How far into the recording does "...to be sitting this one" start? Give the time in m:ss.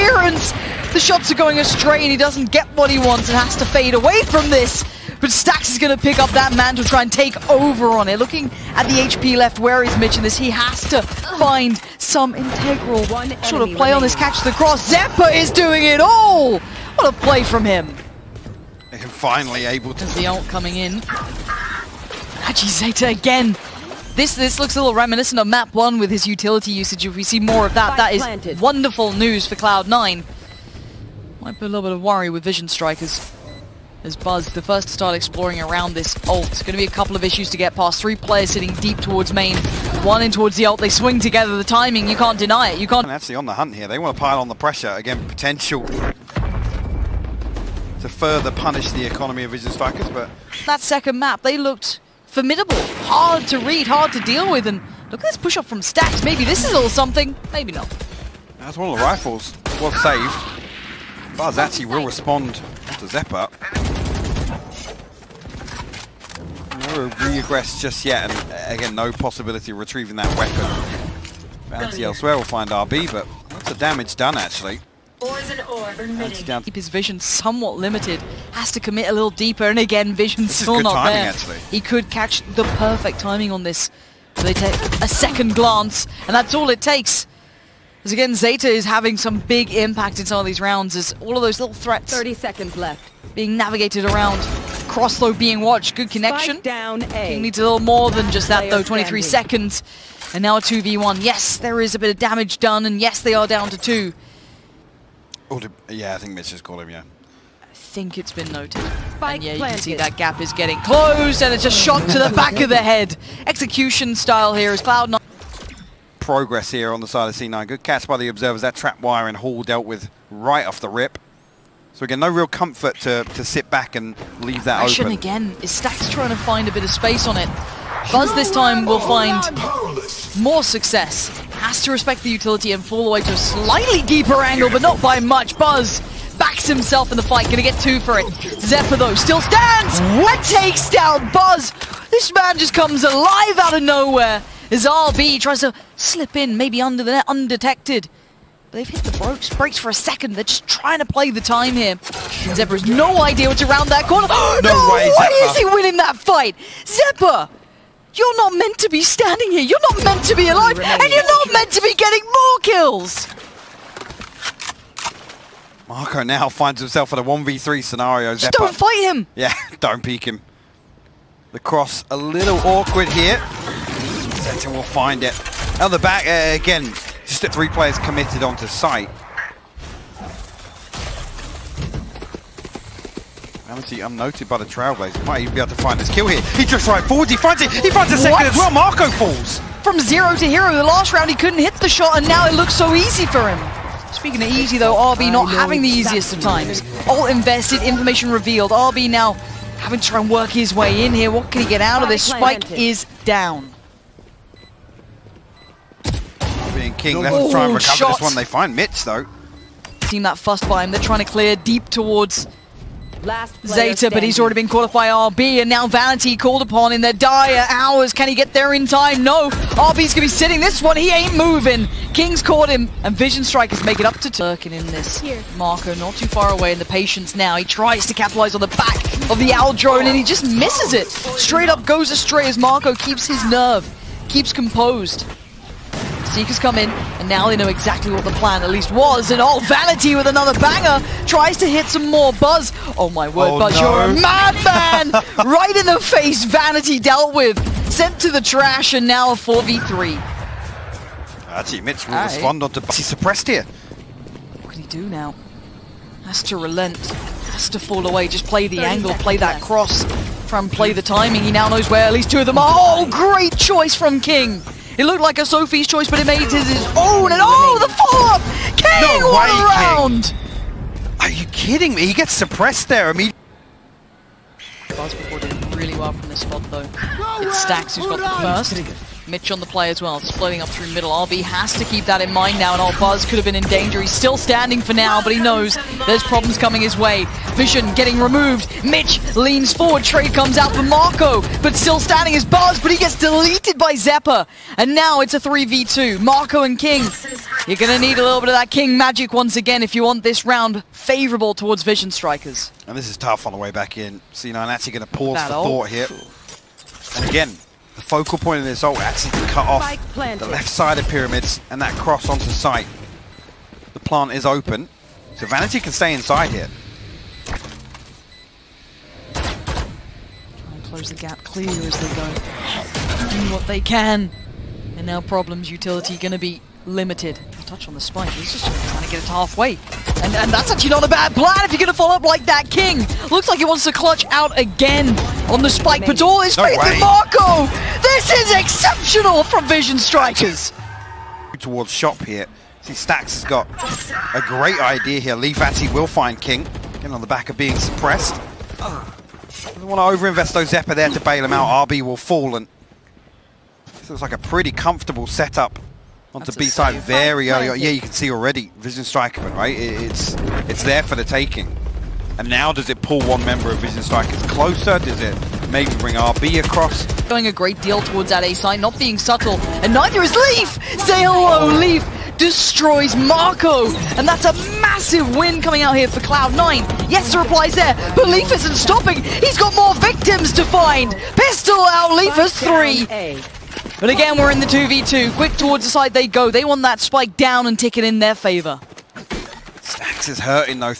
3:40.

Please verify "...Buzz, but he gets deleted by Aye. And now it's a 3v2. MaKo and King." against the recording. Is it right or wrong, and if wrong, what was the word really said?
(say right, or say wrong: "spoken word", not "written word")
wrong: "Xeppaa", not "Aye".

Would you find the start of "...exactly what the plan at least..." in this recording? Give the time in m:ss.
3:57.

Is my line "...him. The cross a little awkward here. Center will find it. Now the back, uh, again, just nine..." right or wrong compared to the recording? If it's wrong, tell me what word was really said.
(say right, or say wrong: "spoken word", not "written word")
wrong: "three", not "nine".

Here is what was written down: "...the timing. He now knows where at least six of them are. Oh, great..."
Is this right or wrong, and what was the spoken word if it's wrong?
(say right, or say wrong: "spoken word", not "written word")
wrong: "two", not "six".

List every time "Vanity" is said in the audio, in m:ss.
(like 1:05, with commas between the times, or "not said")
3:35, 3:59, 4:06, 5:15.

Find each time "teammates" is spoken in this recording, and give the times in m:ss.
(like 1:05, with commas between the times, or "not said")
4:11.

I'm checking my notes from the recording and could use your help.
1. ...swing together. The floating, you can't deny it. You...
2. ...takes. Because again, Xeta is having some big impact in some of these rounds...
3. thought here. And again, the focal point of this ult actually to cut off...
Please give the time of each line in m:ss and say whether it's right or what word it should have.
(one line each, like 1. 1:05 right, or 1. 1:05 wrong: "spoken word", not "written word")
1. 0:40 wrong: "timing", not "floating"
2. 1:26 right
3. 5:05 right.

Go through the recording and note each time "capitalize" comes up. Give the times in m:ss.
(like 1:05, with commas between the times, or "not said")
3:48.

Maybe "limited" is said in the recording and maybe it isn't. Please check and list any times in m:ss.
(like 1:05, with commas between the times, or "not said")
1:17, 5:26.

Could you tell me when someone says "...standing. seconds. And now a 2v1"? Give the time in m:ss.
1:39.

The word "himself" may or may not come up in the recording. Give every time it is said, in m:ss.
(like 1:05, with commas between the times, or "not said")
2:16, 2:46.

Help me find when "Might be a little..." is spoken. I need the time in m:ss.
0:31.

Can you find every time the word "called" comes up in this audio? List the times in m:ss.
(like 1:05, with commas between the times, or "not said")
1:46, 3:36.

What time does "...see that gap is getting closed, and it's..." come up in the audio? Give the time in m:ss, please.
1:49.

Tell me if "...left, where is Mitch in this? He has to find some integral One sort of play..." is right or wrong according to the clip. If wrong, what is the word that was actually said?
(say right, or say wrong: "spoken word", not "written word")
right.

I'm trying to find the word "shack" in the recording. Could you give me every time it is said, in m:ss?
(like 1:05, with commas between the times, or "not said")
not said.